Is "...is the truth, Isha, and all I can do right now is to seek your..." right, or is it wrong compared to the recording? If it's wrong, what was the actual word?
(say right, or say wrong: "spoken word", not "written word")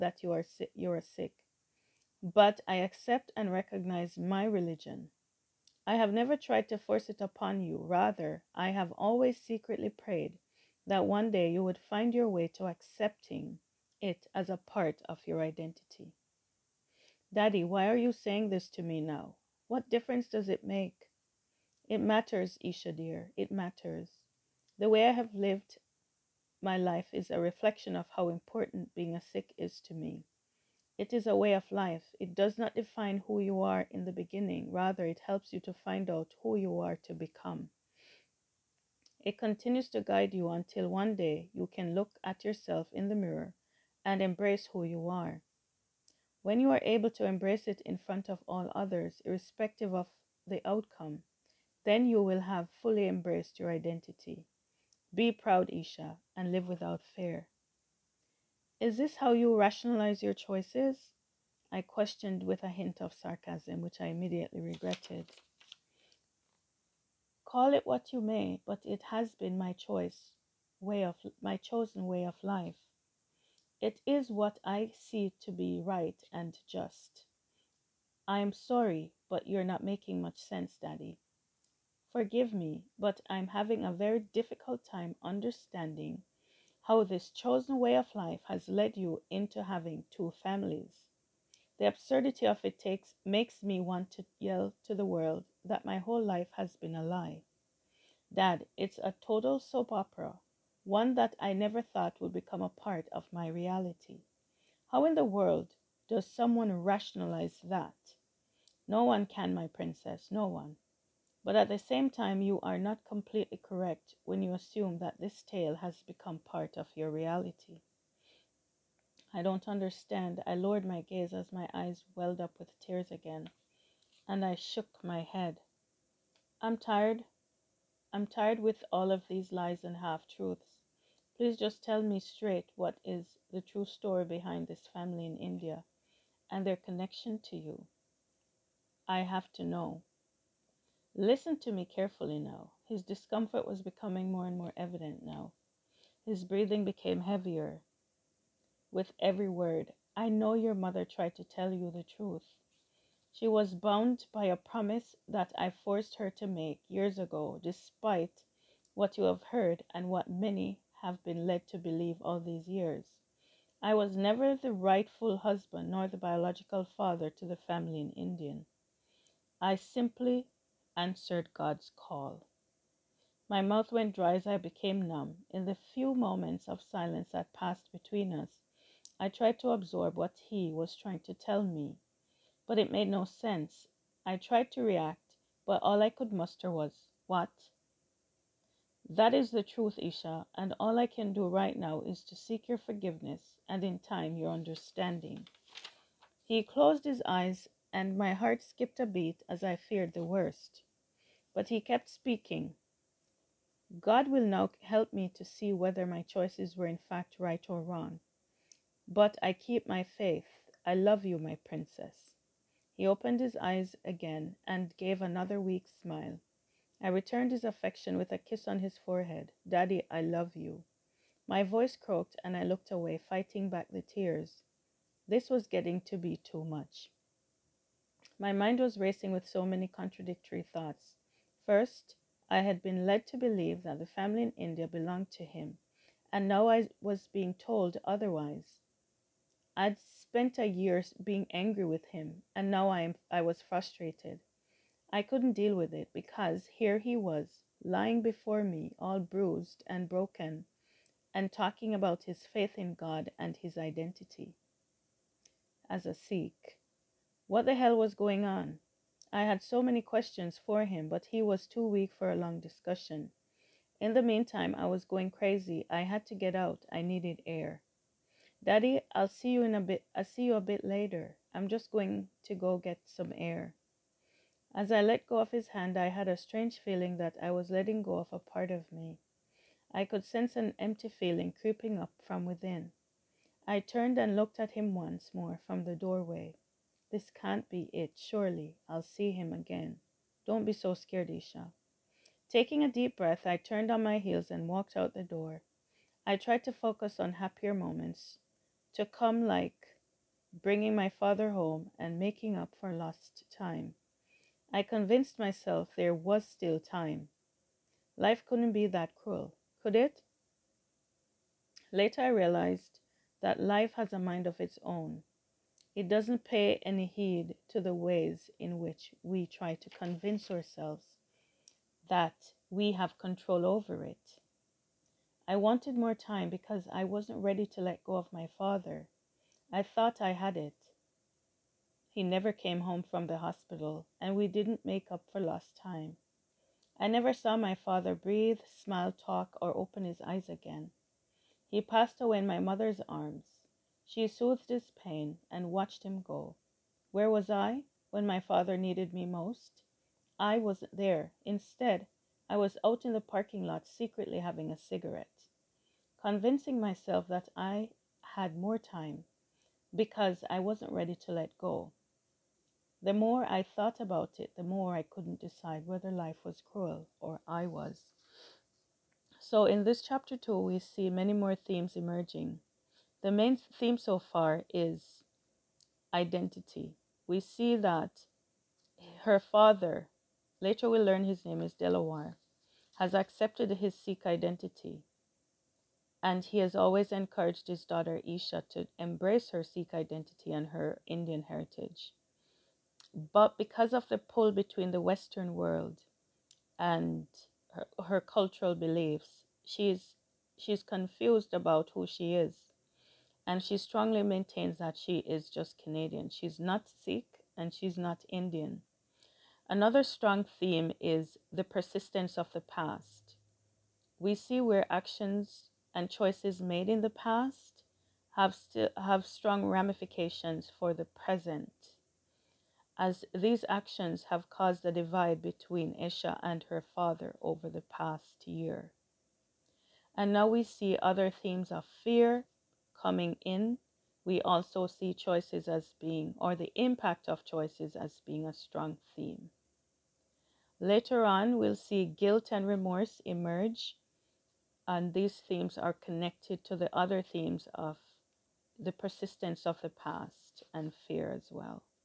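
right.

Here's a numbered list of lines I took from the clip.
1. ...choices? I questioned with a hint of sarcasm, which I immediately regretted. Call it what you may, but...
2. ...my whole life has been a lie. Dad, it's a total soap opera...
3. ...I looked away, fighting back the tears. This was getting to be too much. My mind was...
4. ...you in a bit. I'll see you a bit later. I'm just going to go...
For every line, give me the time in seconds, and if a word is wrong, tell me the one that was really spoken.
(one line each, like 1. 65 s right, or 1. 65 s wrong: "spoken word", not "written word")
1. 60 s right
2. 95 s right
3. 222 s right
4. 269 s right.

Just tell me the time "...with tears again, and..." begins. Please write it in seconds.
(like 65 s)
122 s.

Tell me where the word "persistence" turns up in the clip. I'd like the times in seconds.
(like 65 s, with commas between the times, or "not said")
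411 s, 448 s.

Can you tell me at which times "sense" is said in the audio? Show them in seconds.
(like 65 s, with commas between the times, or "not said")
80 s, 183 s, 280 s.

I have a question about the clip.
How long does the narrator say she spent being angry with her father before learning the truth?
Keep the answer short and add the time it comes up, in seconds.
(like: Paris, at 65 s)
a year, at 240 s.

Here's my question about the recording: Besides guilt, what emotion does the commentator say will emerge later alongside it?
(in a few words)
remorse.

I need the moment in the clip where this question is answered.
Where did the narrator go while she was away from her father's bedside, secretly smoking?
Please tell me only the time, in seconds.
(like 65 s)
353 s.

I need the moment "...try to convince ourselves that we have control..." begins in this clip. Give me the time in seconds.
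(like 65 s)
319 s.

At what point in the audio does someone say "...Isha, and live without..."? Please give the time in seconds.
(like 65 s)
55 s.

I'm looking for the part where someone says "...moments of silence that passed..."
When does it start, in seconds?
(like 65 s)
176 s.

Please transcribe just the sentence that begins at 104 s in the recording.
How in the world does someone rationalize that?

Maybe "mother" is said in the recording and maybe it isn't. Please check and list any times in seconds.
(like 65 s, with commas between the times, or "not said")
150 s, 342 s.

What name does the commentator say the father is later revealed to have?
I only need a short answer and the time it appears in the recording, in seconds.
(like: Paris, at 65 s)
Dilawar, at 381 s.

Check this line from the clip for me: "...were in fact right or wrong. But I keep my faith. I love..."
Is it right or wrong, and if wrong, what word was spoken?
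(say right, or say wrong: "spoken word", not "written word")
right.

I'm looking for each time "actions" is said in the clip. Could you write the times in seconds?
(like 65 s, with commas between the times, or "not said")
414 s, 423 s.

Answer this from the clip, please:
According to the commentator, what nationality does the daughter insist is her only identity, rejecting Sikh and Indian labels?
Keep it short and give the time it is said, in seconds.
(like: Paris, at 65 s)
Canadian, at 405 s.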